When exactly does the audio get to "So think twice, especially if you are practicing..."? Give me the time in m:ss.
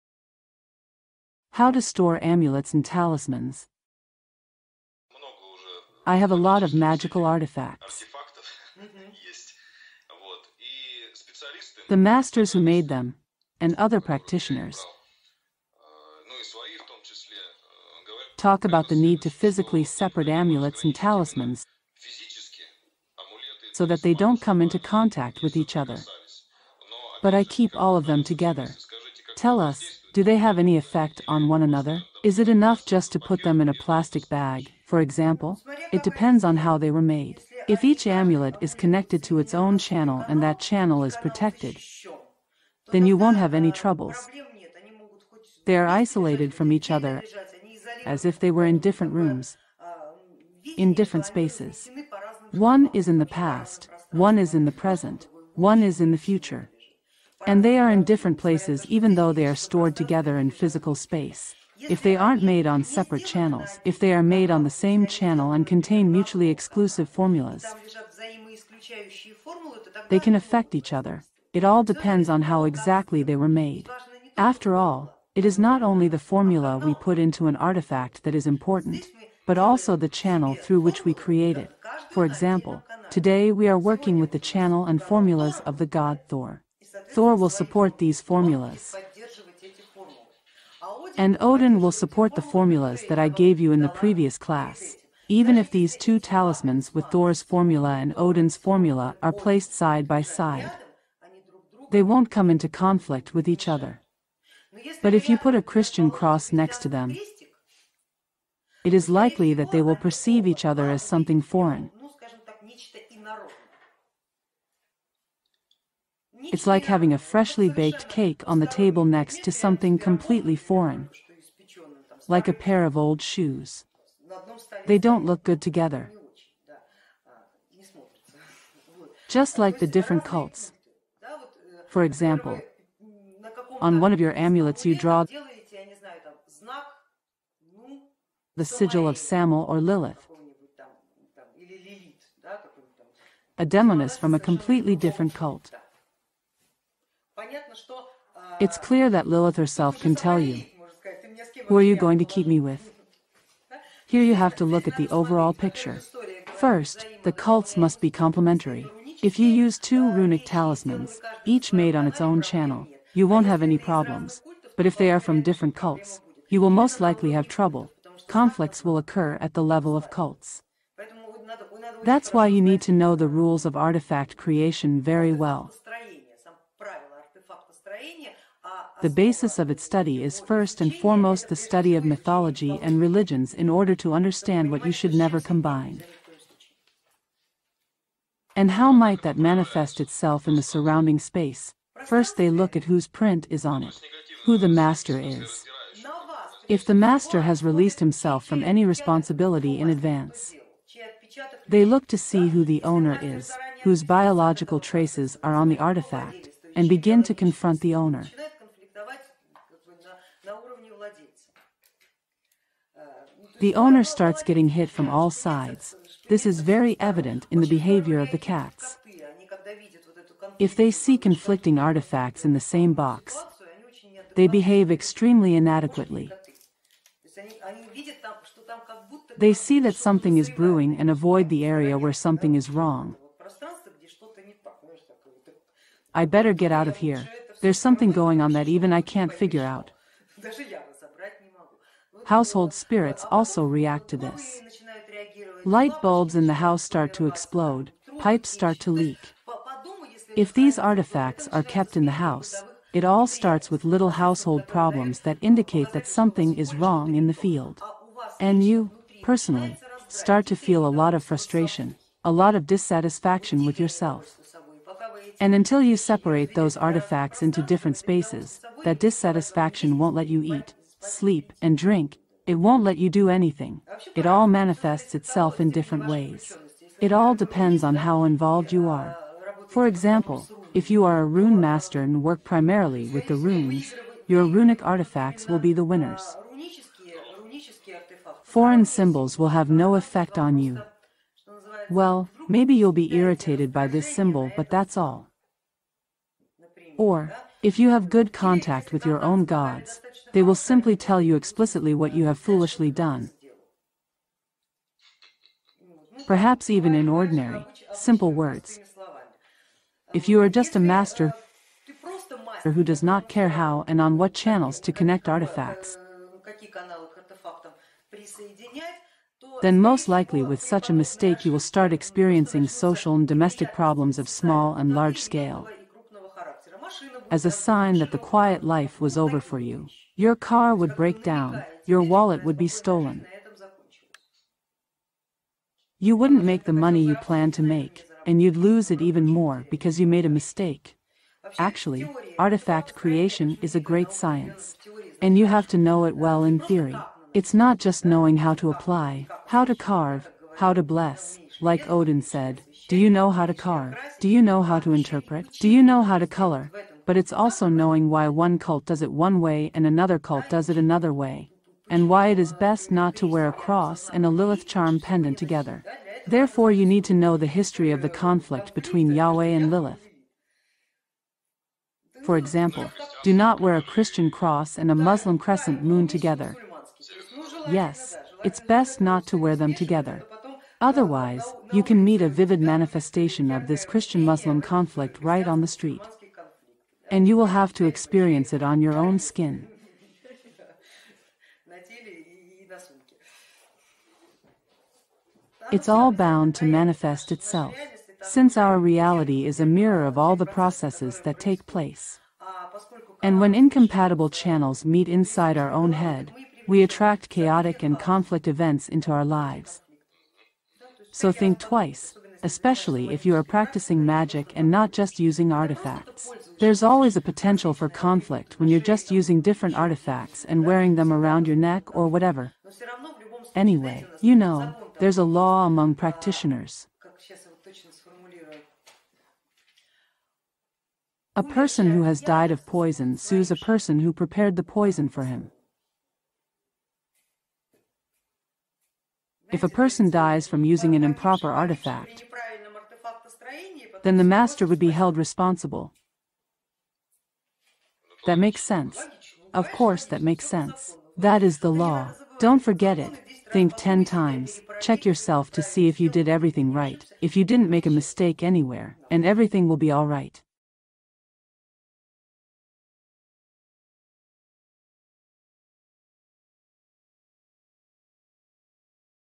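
6:51.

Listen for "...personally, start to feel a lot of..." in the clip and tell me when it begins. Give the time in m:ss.
4:19.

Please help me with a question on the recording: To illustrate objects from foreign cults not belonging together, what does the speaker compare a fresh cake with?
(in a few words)
a pair of old shoes.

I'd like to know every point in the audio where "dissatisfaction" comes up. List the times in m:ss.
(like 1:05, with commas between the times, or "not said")
4:22, 4:28.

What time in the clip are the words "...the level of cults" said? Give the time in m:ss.
2:49.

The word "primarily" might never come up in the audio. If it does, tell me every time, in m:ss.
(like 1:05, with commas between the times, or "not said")
4:42.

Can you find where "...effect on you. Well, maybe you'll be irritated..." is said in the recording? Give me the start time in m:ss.
4:49.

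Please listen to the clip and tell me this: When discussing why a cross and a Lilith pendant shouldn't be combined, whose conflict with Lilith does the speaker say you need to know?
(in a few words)
Yahweh.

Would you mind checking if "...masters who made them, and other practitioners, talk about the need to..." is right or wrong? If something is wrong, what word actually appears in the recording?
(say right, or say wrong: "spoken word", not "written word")
right.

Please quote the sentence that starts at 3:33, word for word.
The owner starts getting hit from all sides.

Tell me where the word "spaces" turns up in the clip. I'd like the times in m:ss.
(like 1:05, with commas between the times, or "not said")
0:51, 1:00, 3:11, 4:27.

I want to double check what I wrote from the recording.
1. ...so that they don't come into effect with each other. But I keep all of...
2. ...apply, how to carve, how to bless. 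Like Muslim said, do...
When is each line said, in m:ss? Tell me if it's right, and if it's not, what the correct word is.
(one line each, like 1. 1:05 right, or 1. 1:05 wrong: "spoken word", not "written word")
1. 0:23 wrong: "contact", not "effect"
2. 5:48 wrong: "Odin", not "Muslim".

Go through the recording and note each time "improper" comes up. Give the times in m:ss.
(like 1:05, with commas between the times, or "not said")
7:21.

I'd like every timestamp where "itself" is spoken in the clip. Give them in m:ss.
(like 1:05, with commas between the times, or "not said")
3:09, 4:35, 6:37.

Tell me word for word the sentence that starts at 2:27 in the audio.
Э, it's clear that Lilith herself can tell you who are you going to keep me with.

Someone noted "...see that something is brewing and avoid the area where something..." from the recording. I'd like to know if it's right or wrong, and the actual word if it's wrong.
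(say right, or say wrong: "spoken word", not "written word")
right.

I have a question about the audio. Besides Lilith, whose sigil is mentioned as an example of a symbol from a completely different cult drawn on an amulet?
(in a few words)
Samael.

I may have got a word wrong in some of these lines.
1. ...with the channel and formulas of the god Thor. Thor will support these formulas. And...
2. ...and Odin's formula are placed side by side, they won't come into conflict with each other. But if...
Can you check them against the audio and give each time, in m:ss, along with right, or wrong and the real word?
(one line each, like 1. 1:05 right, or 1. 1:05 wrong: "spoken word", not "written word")
1. 1:24 right
2. 1:37 right.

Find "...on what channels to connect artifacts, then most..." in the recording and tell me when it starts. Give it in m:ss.
5:13.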